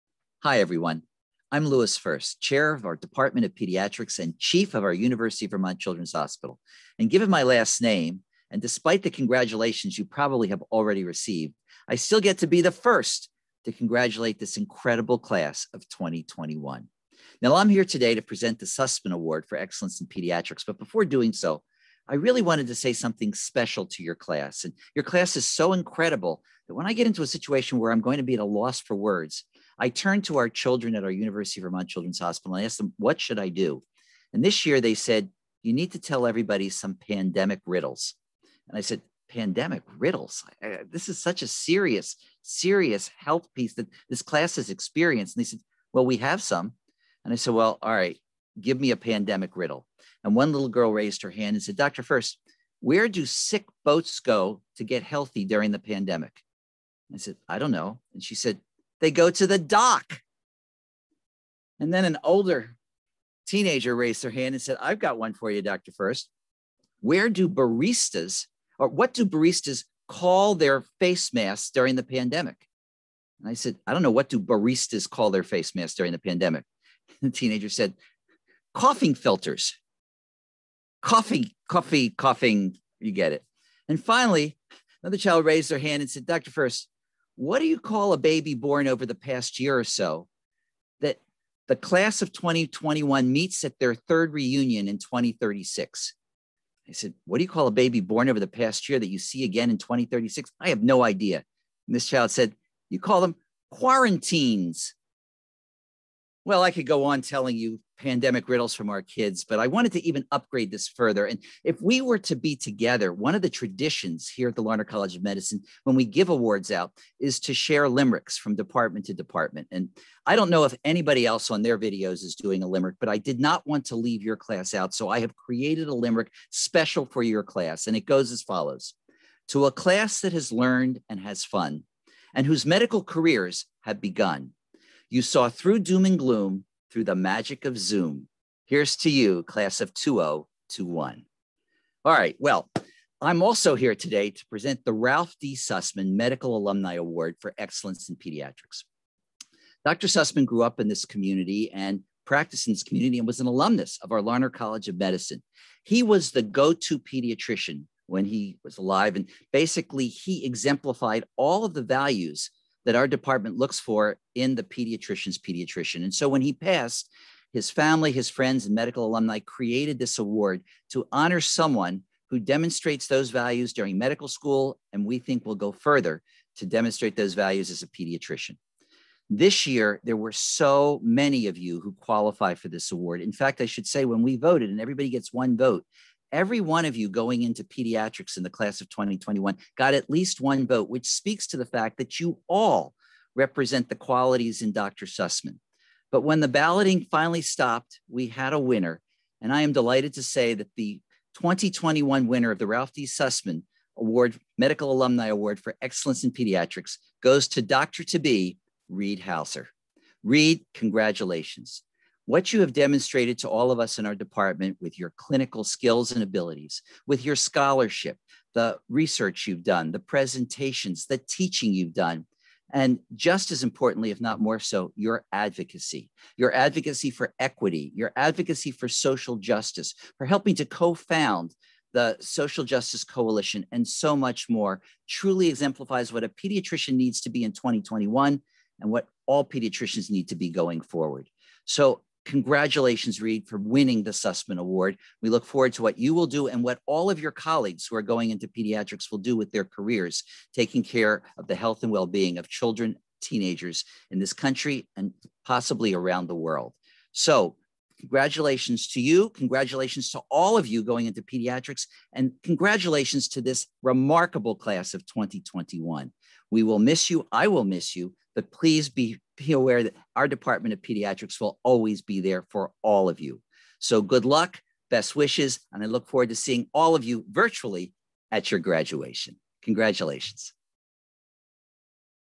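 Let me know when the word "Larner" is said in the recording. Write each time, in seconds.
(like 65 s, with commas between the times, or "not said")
114 s, 154 s.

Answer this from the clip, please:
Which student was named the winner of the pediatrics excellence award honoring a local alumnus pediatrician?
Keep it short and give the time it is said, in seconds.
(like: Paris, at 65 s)
Reed Hauser, at 208 s.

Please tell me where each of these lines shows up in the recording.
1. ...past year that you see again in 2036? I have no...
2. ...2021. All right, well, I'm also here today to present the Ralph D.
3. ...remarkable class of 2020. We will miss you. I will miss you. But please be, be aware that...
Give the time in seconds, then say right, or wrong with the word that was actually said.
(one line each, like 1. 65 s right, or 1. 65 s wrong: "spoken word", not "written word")
1. 98 s right
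2. 139 s right
3. 263 s wrong: "2021", not "2020".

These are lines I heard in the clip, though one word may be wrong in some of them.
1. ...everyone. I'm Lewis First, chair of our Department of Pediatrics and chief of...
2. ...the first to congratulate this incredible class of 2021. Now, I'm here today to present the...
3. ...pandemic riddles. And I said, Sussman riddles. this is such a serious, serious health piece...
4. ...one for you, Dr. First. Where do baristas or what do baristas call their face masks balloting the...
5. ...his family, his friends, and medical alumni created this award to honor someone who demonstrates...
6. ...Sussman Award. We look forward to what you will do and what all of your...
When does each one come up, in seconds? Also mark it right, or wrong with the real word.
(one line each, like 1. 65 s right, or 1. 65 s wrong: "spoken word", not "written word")
1. 0 s right
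2. 12 s right
3. 36 s wrong: "Pandemic", not "Sussman"
4. 65 s wrong: "during", not "balloting"
5. 167 s right
6. 244 s right.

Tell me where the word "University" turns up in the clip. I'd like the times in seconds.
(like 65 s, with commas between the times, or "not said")
4 s, 31 s.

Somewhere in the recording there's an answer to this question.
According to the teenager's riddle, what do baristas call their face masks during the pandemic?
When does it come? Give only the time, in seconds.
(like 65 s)
78 s.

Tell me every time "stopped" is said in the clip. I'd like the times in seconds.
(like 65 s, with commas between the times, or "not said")
197 s.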